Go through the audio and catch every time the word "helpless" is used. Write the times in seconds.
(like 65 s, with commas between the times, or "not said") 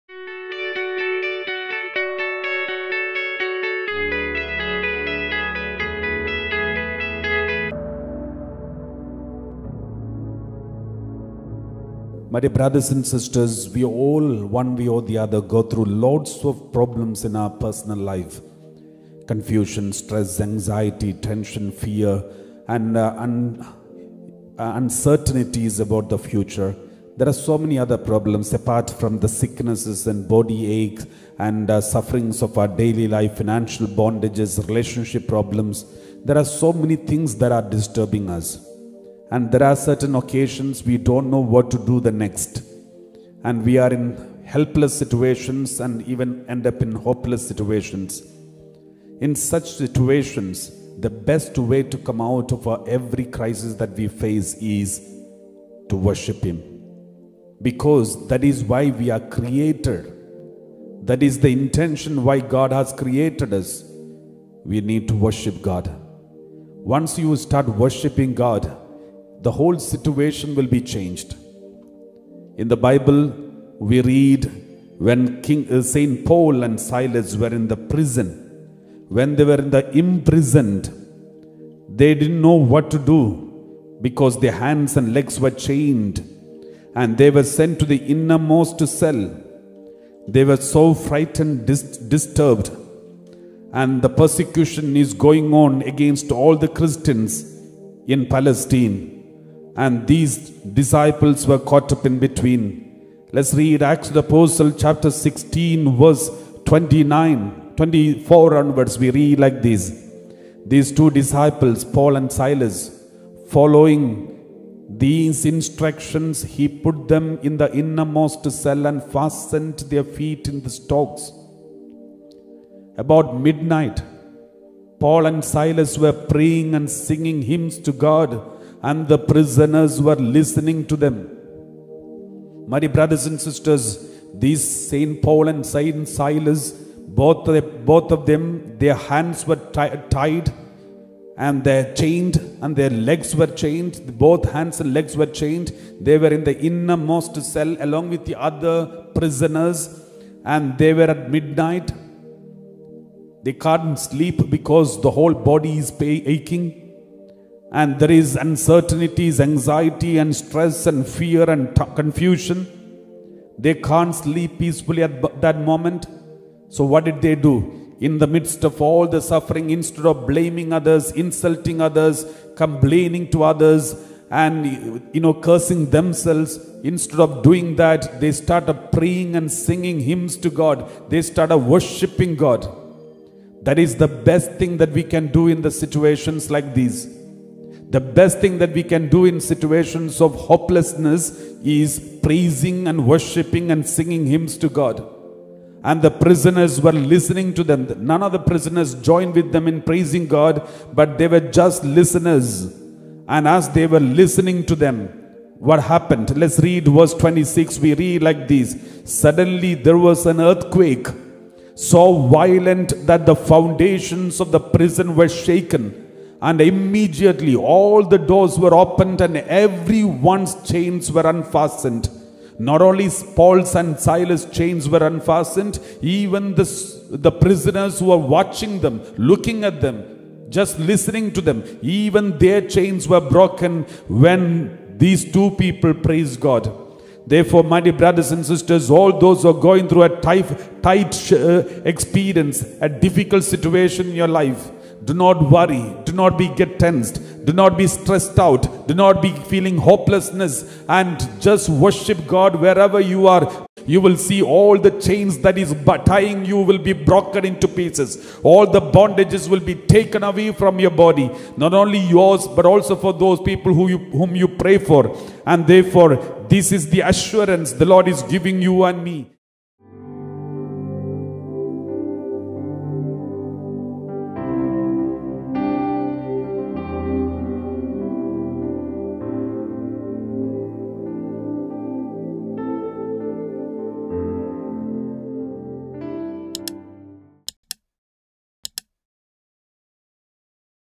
44 s.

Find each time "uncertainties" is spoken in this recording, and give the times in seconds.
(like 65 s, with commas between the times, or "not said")
24 s, 158 s.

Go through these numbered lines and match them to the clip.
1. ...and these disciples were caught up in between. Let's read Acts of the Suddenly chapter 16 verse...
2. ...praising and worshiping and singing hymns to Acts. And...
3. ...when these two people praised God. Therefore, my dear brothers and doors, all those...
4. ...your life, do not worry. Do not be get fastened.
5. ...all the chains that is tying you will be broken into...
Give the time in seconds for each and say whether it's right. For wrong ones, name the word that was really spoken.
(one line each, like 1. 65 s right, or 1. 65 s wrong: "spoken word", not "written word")
1. 99 s wrong: "Apostle", not "Suddenly"
2. 192 s wrong: "God", not "Acts"
3. 234 s wrong: "sisters", not "doors"
4. 244 s wrong: "tensed", not "fastened"
5. 254 s right.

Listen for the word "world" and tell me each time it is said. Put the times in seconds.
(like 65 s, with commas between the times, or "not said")
not said.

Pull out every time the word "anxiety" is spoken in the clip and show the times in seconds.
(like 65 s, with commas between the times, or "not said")
20 s, 159 s.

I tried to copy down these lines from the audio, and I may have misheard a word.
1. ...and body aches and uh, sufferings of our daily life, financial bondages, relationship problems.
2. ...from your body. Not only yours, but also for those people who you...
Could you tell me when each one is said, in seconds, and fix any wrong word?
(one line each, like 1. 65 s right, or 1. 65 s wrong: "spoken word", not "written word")
1. 30 s right
2. 260 s right.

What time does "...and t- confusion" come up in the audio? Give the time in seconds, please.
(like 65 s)
161 s.